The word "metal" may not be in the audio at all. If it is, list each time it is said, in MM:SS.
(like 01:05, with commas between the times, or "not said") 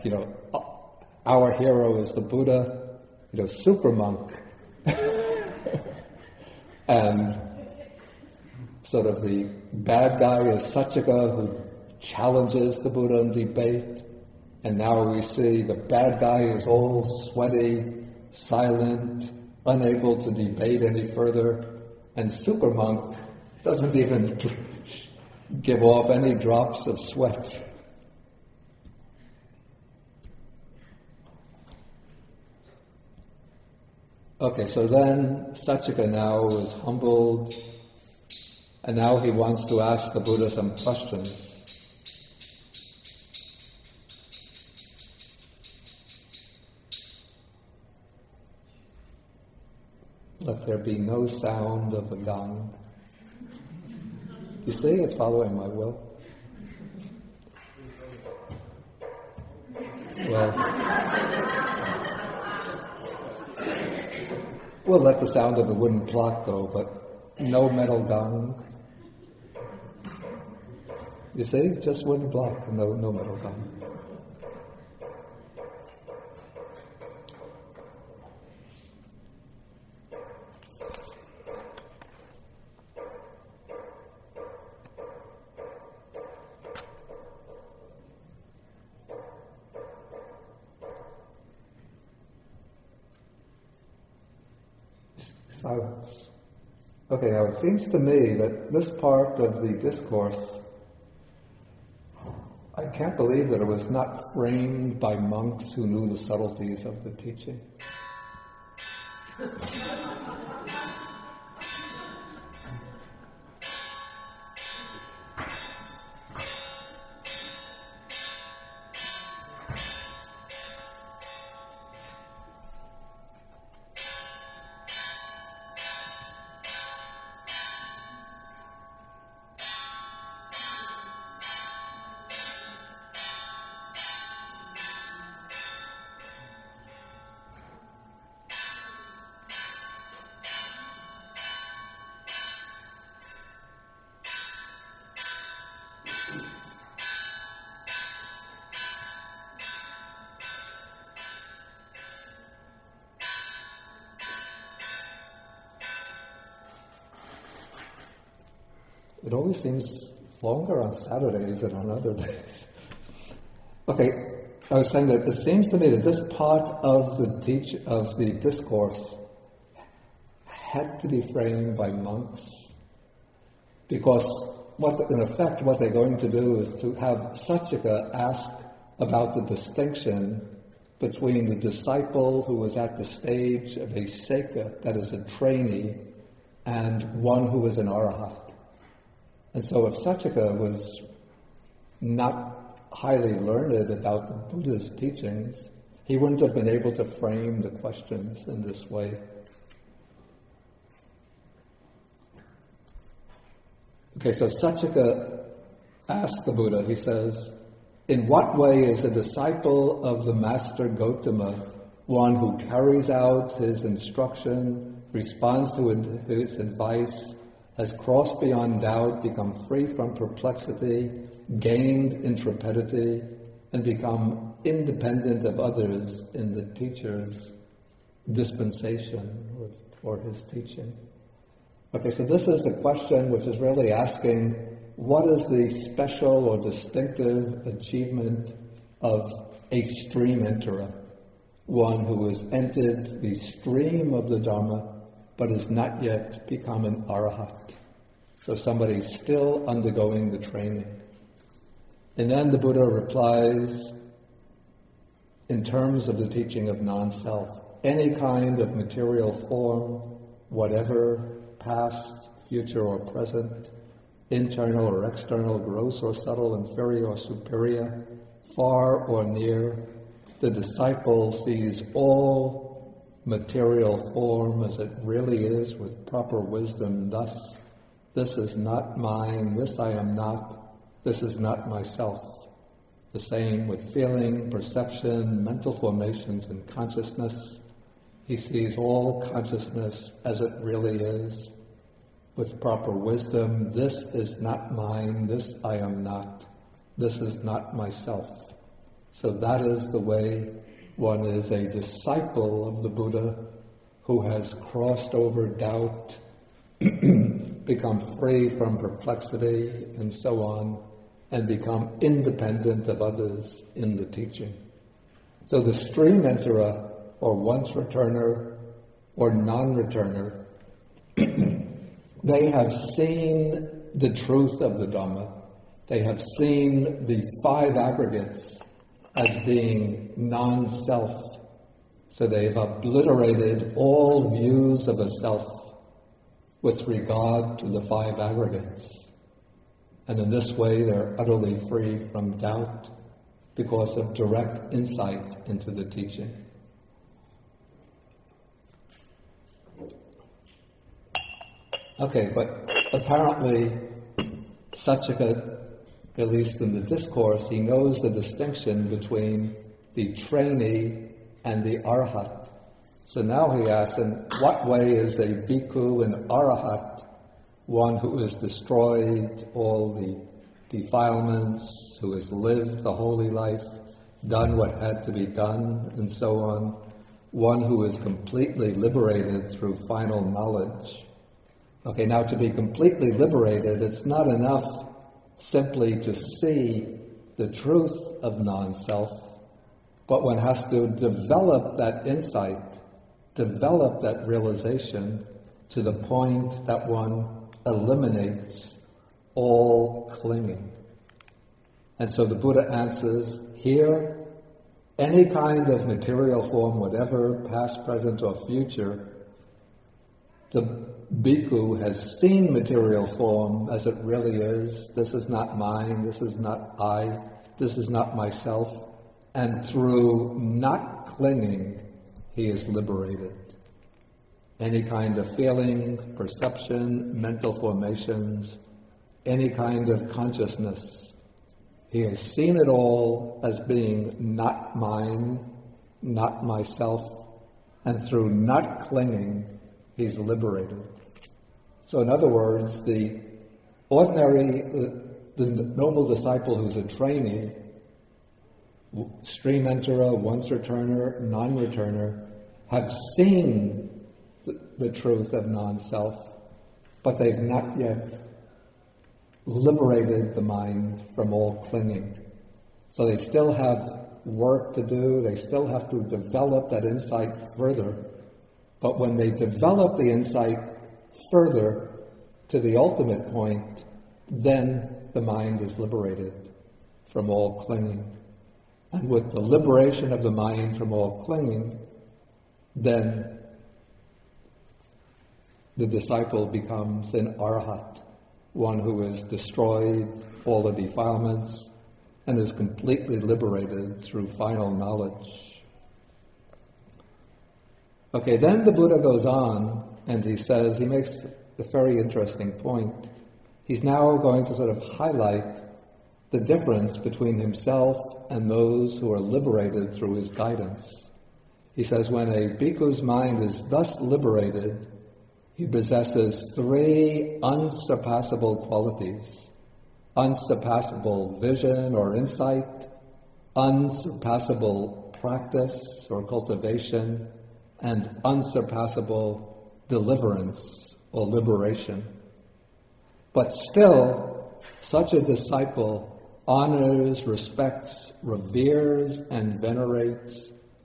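01:07, 01:13.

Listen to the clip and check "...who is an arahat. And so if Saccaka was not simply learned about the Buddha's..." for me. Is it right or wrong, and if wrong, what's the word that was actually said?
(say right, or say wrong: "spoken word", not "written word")
wrong: "highly", not "simply".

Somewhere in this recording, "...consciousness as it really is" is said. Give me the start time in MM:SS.
04:49.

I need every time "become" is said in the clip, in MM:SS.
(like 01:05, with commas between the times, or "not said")
03:39, 03:43, 04:06, 05:06, 05:11, 08:06.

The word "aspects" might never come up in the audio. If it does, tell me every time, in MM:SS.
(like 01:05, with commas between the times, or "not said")
not said.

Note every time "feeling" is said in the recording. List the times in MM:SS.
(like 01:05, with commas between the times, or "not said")
04:43, 07:05.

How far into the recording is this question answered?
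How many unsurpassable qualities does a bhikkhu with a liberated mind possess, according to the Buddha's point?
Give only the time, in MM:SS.
08:36.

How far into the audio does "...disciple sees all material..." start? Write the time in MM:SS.
04:30.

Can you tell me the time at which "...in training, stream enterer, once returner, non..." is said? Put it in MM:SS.
07:26.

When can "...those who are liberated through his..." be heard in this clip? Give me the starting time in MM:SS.
08:28.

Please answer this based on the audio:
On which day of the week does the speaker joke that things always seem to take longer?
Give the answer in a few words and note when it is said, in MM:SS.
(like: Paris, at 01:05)
Saturdays, at 02:40.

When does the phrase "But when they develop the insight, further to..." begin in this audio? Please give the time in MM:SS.
07:48.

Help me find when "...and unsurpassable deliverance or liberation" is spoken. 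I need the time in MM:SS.
08:47.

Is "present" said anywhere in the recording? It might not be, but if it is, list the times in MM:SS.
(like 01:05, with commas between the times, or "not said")
04:23, 06:47.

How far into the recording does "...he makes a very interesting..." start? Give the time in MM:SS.
08:20.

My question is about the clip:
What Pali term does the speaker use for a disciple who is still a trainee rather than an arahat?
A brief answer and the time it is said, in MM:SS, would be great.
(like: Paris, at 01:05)
seka, at 03:04.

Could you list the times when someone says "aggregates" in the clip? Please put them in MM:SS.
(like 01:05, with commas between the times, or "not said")
05:27, 05:38.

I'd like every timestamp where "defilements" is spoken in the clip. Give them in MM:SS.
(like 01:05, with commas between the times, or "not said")
06:10, 08:10.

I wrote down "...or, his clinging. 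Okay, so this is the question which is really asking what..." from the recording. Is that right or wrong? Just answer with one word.
wrong.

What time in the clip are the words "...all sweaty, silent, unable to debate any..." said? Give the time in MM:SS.
00:16.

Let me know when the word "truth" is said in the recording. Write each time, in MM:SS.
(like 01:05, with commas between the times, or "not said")
05:24, 06:27, 07:34.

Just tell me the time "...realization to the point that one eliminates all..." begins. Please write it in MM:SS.
06:34.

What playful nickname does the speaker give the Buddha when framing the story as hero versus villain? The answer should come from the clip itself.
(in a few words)
Super monk.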